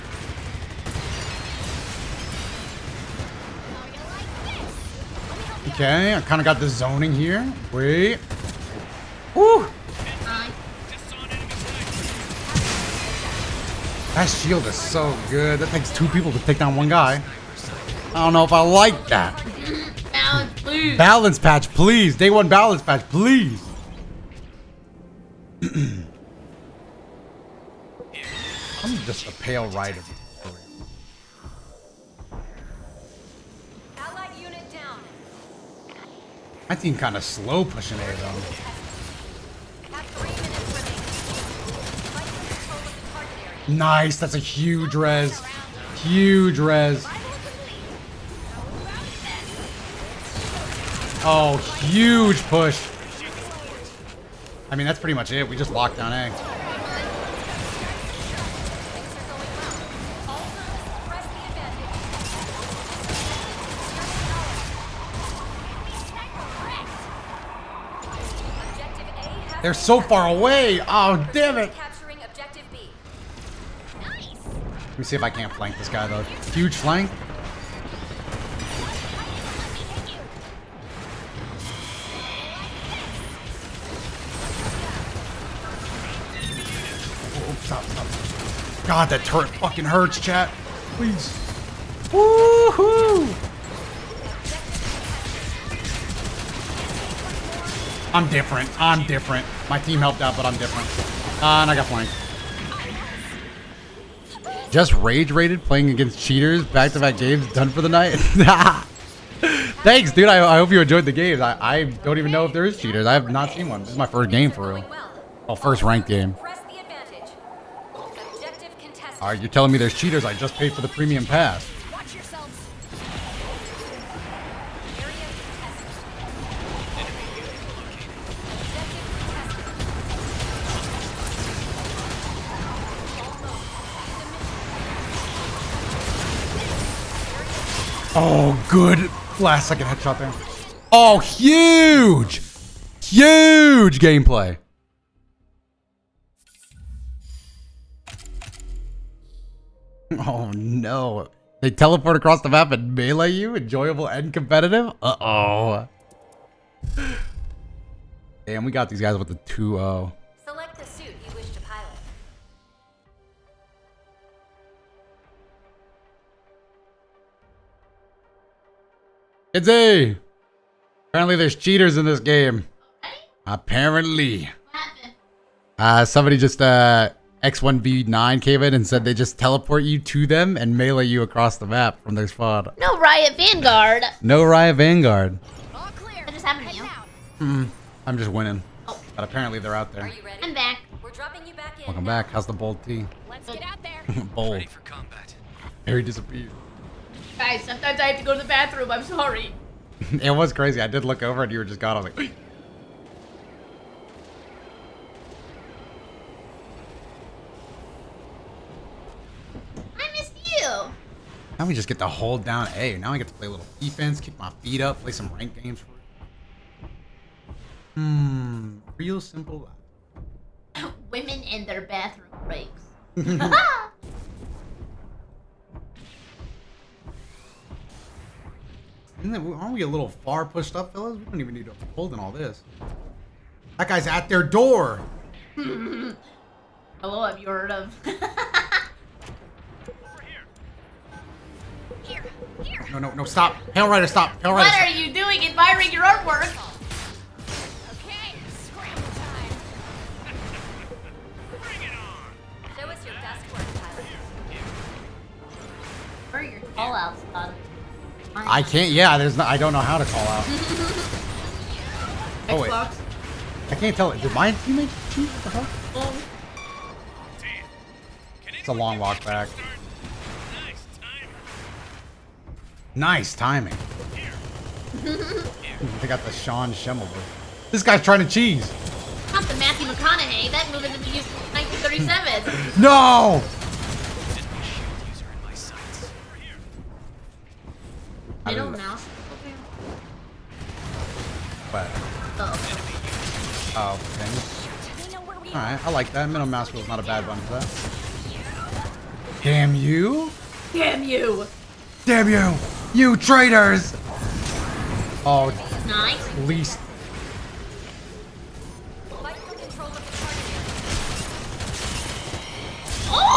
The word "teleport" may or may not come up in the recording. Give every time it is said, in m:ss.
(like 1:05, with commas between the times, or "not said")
2:31, 2:59.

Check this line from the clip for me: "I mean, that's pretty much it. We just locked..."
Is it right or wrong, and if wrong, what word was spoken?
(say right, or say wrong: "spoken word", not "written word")
right.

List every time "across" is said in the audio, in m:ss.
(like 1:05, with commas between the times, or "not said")
2:32, 3:01.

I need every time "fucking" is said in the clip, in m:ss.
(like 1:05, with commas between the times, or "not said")
1:29.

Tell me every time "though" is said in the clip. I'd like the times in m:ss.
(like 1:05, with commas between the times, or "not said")
0:38, 1:16.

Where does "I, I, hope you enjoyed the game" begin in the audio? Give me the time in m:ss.
1:50.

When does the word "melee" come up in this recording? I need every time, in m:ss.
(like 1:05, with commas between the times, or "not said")
2:32, 3:00.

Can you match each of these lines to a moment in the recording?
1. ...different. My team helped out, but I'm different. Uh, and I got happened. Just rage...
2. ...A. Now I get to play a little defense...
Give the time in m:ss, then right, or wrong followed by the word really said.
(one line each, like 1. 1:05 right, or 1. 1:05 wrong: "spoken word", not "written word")
1. 1:39 wrong: "flanked", not "happened"
2. 3:32 right.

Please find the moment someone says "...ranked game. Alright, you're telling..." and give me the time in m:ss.
1:55.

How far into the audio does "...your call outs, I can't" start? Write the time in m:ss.
4:16.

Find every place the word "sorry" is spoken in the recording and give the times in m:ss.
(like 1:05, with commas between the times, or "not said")
3:19.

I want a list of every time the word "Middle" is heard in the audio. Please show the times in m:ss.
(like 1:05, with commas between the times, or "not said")
4:48, 4:56.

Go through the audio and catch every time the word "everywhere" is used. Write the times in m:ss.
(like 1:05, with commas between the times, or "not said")
not said.